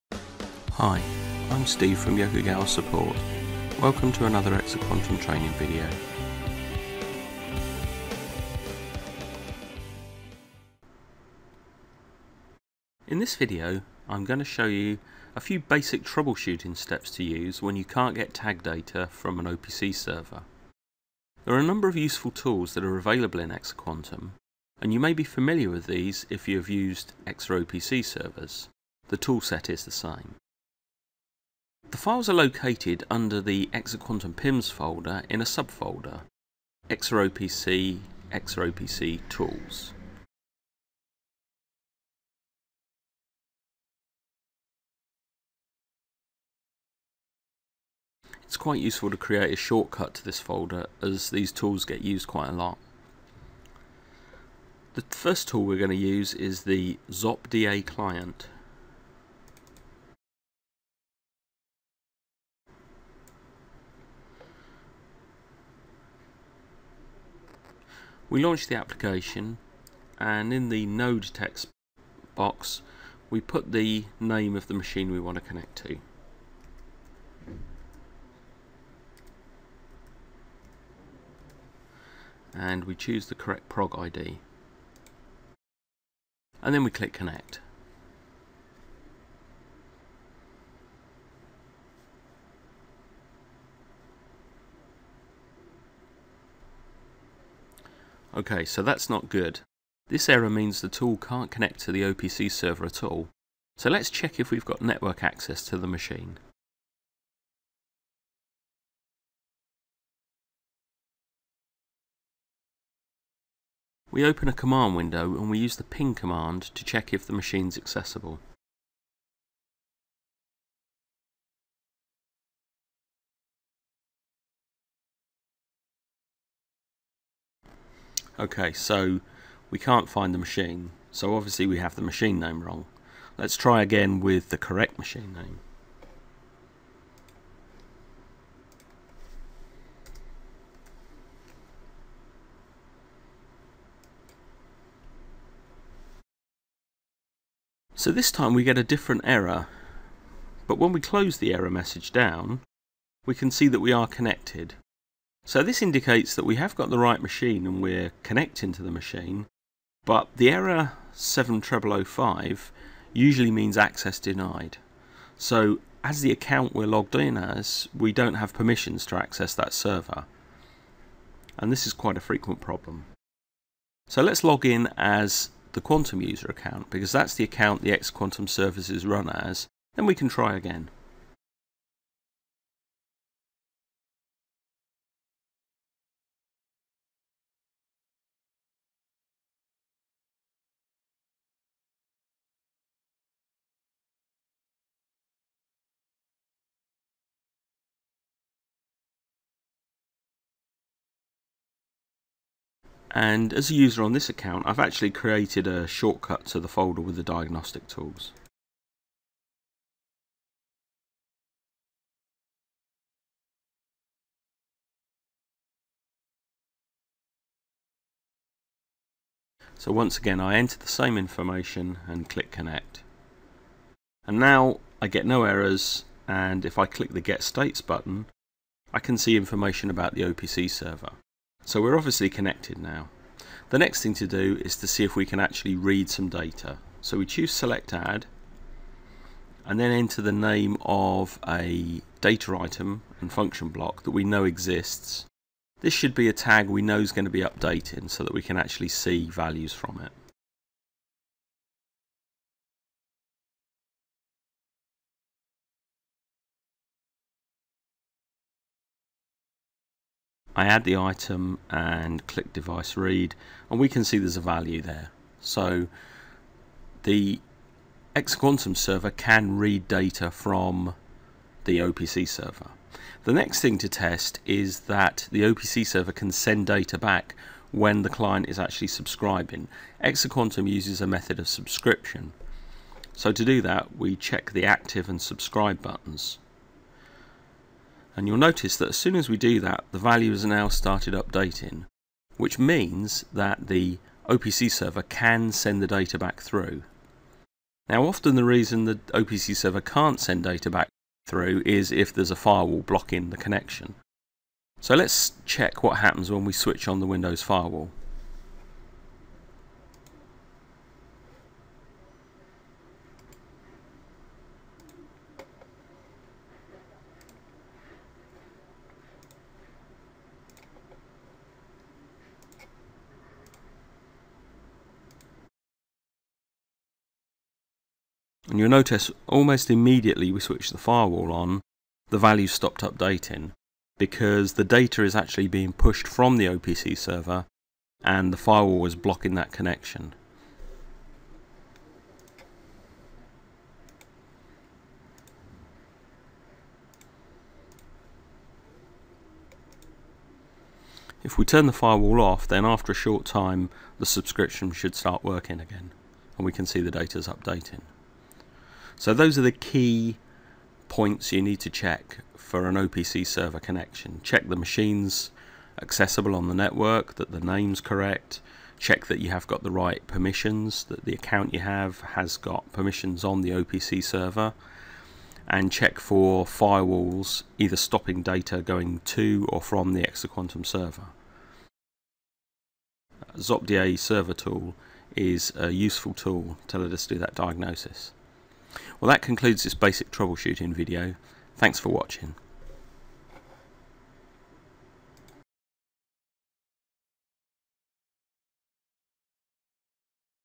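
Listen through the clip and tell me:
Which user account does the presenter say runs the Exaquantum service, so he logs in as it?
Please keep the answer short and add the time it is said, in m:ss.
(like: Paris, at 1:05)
Quantum user account, at 2:55.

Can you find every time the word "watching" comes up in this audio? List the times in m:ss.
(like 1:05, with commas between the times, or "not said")
6:31.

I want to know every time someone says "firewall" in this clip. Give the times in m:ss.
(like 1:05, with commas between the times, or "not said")
5:02, 5:07, 5:30, 5:38, 5:51, 6:16.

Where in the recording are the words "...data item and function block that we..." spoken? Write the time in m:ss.
4:02.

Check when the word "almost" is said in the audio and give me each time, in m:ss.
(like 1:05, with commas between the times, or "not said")
5:29.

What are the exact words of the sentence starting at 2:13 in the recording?
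Let's try again with the correct machine name.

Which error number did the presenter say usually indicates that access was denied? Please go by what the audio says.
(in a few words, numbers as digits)
7005.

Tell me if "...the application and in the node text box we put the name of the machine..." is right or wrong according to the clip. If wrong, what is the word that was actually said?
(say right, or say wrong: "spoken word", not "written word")
right.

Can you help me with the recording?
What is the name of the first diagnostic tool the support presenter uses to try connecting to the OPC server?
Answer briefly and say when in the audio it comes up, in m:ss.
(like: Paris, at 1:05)
ZopDA client, at 0:57.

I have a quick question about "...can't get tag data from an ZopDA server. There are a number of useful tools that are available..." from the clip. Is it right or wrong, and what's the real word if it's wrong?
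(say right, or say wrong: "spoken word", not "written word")
wrong: "OPC", not "ZopDA".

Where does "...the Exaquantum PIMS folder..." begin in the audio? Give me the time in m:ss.
0:33.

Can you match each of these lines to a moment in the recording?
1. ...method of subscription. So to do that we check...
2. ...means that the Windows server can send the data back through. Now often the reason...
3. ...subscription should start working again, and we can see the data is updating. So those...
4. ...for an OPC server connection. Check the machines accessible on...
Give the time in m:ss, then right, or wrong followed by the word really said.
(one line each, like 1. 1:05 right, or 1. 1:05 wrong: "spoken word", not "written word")
1. 4:41 right
2. 4:52 wrong: "OPC", not "Windows"
3. 5:54 right
4. 6:02 right.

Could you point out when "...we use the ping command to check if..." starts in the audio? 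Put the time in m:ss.
1:55.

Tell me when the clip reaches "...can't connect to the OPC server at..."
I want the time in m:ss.
1:41.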